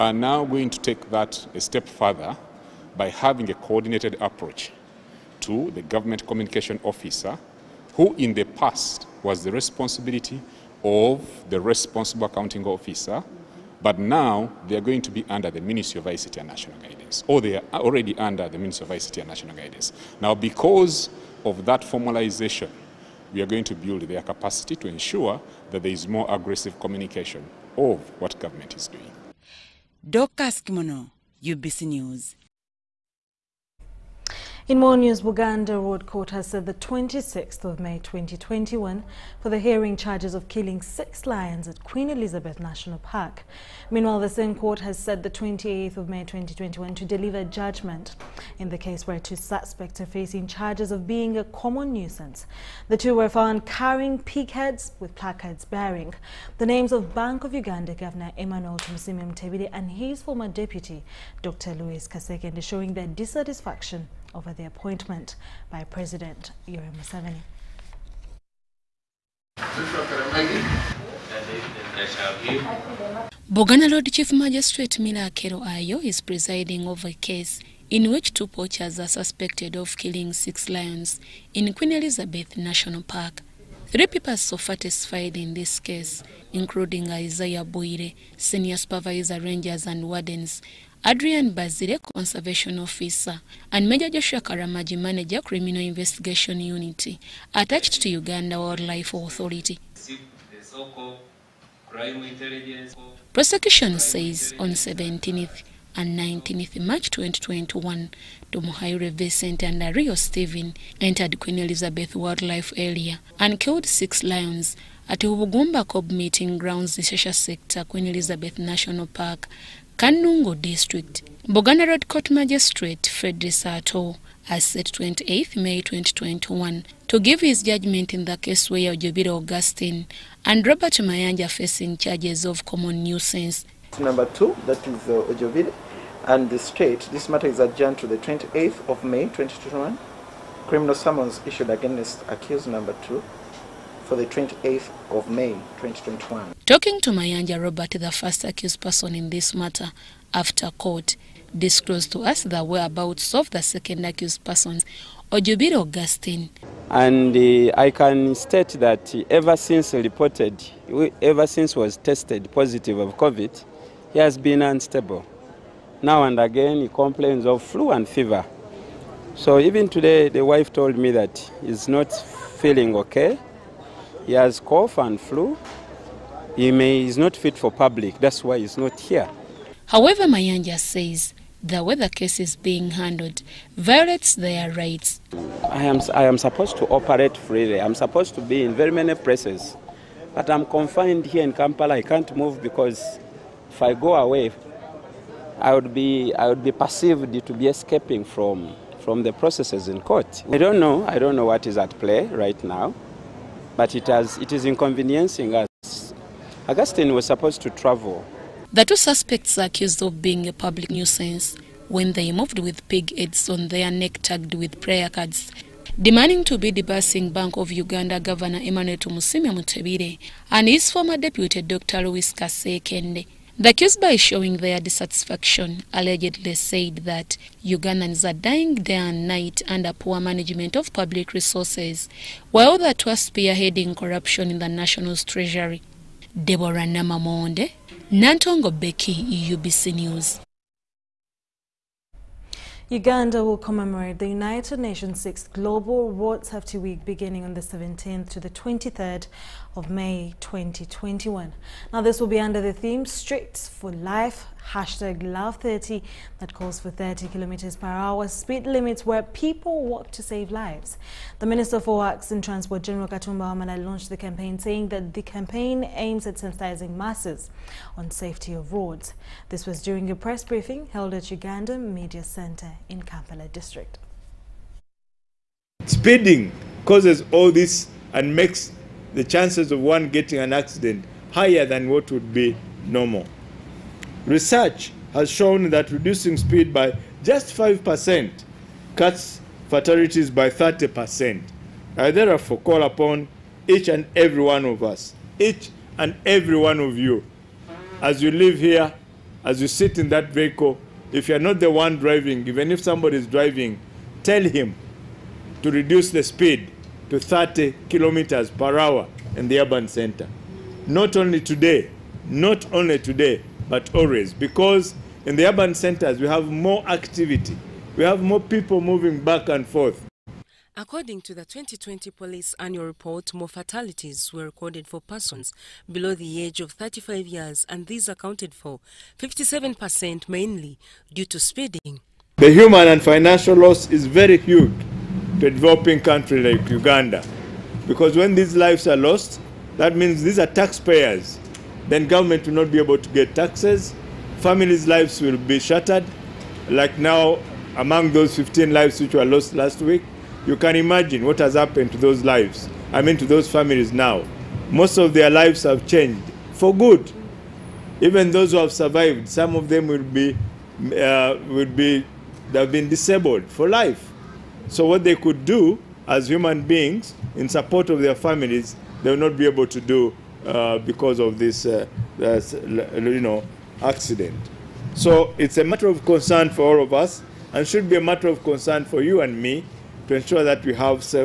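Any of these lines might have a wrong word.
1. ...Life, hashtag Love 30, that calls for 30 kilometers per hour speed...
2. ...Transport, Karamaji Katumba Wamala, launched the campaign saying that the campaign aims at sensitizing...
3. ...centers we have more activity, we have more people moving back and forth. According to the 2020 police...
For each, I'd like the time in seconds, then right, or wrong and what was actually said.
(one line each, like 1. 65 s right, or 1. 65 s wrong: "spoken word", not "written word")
1. 253 s right
2. 262 s wrong: "General", not "Karamaji"
3. 315 s right.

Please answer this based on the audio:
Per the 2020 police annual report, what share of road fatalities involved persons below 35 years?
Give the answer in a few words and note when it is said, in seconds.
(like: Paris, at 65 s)
57%, at 329 s.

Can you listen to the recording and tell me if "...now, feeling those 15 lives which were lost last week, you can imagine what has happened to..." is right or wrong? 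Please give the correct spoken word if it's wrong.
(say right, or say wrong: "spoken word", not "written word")
wrong: "among", not "feeling".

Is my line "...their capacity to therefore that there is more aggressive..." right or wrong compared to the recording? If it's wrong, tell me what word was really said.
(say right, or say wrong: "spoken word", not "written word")
wrong: "ensure", not "therefore".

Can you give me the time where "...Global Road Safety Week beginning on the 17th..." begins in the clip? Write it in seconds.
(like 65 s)
245 s.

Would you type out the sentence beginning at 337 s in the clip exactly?
Because when these lives are lost, that means these are taxpayers.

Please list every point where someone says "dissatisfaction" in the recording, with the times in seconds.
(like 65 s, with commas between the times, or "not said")
63 s, 224 s.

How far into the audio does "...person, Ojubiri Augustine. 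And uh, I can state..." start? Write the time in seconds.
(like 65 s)
154 s.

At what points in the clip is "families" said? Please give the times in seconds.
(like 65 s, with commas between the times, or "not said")
344 s, 353 s, 368 s.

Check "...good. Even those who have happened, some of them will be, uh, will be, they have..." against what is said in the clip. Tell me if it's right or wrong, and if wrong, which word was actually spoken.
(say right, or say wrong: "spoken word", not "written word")
wrong: "survived", not "happened".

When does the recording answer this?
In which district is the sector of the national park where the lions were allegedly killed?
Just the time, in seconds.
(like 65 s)
119 s.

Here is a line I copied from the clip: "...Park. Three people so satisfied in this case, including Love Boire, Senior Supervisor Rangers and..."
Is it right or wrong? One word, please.
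wrong.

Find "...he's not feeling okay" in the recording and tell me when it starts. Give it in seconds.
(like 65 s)
171 s.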